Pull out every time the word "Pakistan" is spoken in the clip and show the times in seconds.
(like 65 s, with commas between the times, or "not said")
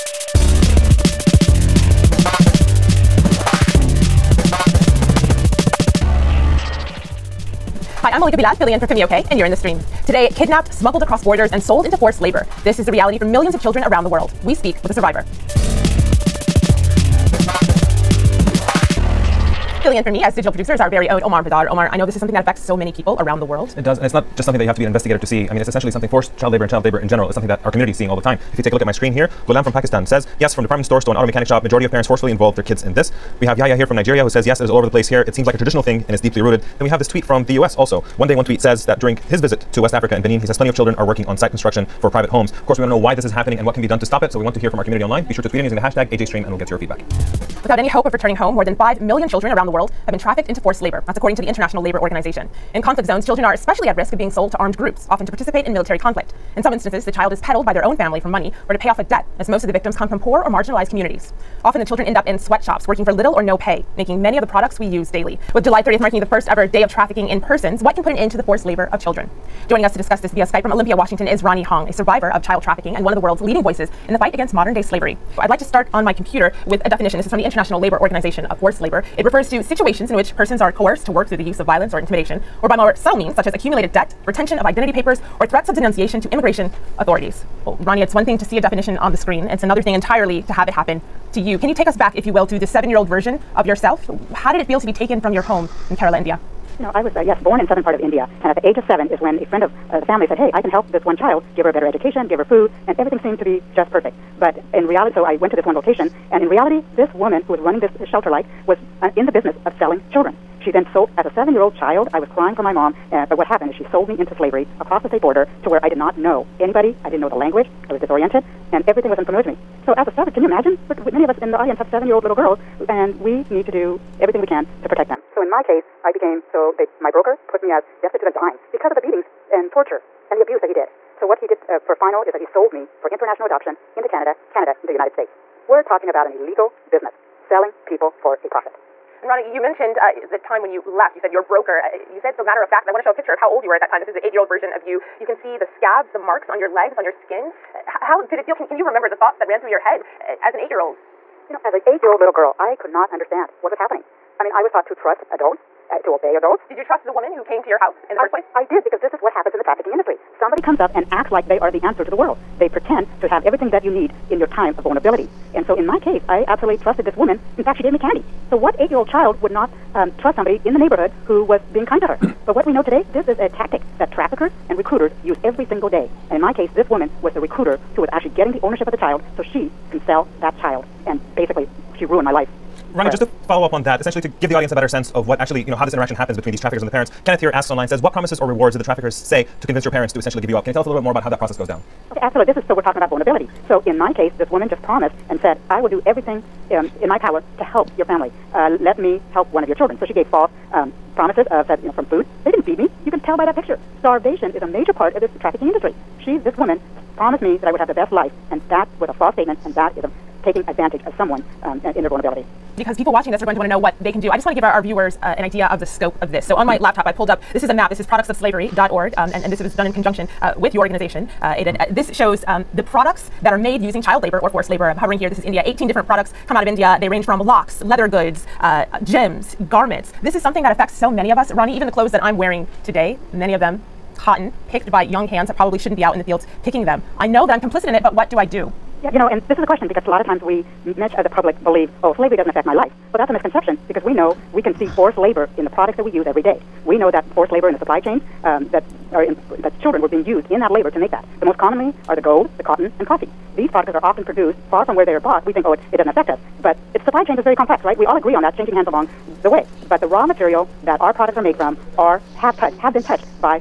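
29 s.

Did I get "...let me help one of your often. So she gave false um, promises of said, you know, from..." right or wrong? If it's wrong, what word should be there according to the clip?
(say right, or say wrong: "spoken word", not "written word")
wrong: "children", not "often".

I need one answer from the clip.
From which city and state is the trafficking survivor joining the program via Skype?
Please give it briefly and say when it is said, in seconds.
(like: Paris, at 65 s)
Olympia, Washington, at 70 s.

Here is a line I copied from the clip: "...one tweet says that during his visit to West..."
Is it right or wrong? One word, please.
right.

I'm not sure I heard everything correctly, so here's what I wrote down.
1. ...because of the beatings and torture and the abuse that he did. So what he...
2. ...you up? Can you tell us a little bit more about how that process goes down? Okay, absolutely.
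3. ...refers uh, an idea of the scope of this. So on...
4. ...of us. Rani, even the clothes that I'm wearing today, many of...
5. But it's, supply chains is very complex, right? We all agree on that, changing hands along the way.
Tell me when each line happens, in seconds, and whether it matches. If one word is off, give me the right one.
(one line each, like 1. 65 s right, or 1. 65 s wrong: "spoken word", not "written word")
1. 128 s right
2. 190 s right
3. 214 s wrong: "viewers", not "refers"
4. 231 s right
5. 256 s right.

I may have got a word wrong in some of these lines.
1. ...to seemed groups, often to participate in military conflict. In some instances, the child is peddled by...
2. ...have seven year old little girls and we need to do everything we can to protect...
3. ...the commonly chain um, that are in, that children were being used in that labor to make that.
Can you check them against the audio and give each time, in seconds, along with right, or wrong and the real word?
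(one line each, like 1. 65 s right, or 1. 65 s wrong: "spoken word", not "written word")
1. 54 s wrong: "armed", not "seemed"
2. 121 s right
3. 247 s wrong: "supply", not "commonly".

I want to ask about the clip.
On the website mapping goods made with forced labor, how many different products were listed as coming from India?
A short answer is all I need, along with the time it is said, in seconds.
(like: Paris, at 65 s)
18, at 225 s.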